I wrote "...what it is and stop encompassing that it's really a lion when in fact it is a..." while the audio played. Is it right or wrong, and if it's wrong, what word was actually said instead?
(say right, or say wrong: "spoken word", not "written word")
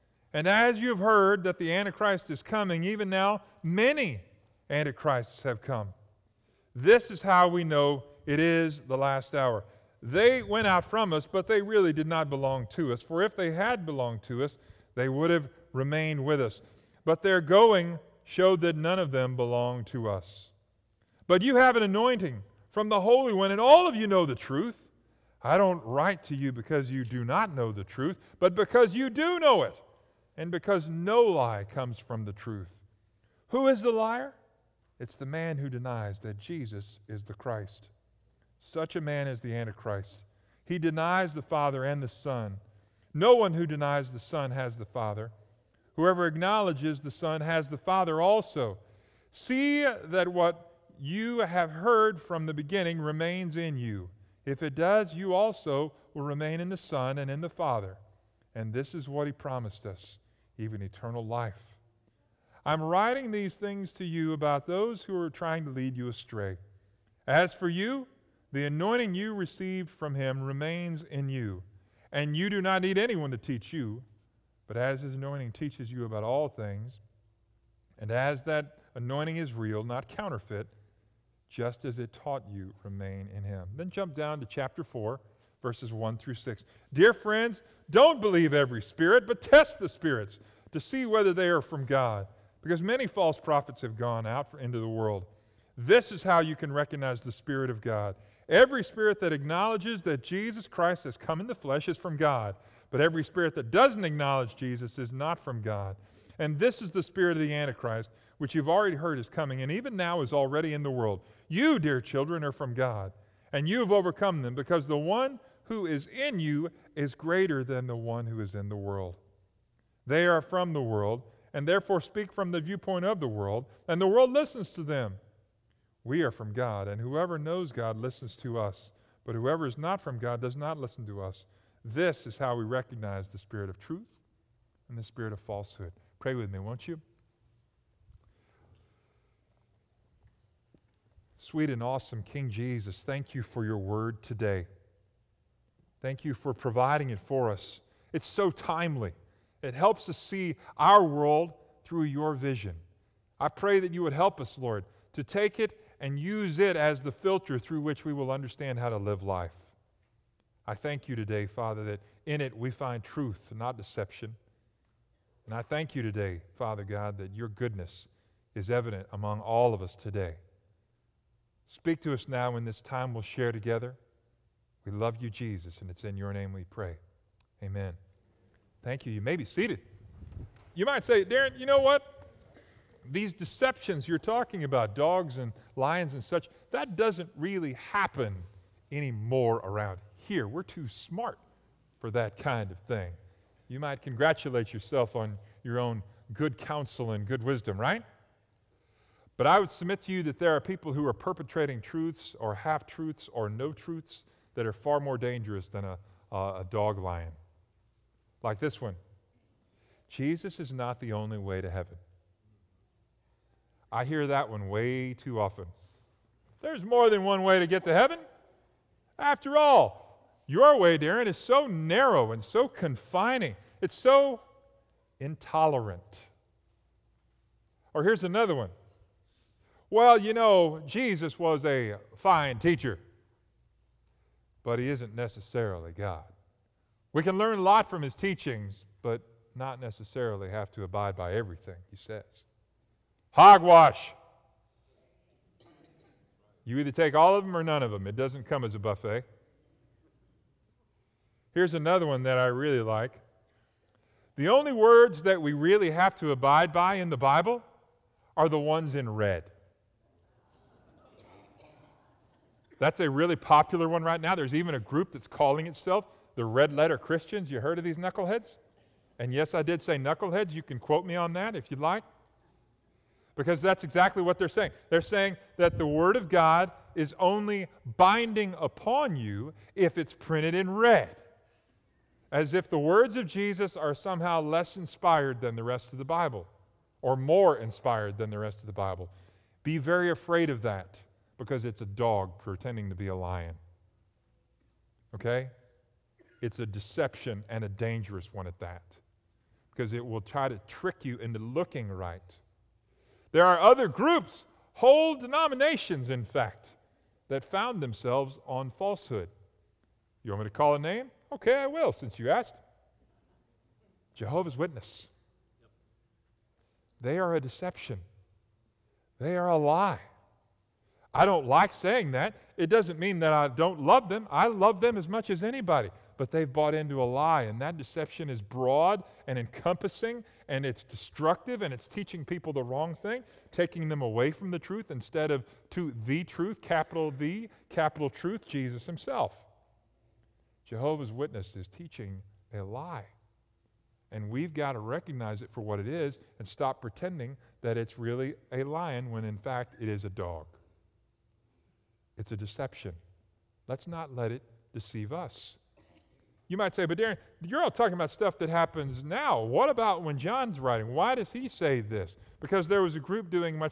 wrong: "pretending", not "encompassing".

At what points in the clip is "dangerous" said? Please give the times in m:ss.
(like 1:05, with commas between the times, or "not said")
3:25, 4:57.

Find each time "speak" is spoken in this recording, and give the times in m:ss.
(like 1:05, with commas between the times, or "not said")
2:02, 2:51.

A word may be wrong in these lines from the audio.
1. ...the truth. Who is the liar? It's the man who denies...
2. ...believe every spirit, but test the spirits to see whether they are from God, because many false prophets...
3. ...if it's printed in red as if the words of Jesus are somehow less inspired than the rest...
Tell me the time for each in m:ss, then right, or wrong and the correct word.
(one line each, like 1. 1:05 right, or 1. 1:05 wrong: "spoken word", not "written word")
1. 0:32 right
2. 1:28 right
3. 4:39 right.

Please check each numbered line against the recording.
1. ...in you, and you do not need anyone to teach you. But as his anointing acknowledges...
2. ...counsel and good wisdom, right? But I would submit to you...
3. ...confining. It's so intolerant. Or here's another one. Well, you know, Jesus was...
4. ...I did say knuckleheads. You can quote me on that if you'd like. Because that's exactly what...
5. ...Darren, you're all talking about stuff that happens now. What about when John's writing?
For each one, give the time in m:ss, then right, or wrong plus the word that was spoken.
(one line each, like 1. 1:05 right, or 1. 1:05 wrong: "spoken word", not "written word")
1. 1:11 wrong: "teaches", not "acknowledges"
2. 3:16 right
3. 3:42 right
4. 4:29 right
5. 5:56 right.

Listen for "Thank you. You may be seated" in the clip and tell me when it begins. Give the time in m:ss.
2:58.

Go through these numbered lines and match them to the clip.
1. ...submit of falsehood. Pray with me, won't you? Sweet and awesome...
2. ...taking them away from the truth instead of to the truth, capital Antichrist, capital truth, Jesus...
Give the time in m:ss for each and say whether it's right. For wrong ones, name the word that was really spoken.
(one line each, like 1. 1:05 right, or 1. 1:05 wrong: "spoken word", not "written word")
1. 2:15 wrong: "spirit", not "submit"
2. 5:33 wrong: "The", not "Antichrist".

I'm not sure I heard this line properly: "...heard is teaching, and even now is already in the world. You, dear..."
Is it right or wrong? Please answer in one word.
wrong.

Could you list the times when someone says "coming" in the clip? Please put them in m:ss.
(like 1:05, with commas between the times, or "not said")
0:02, 1:49.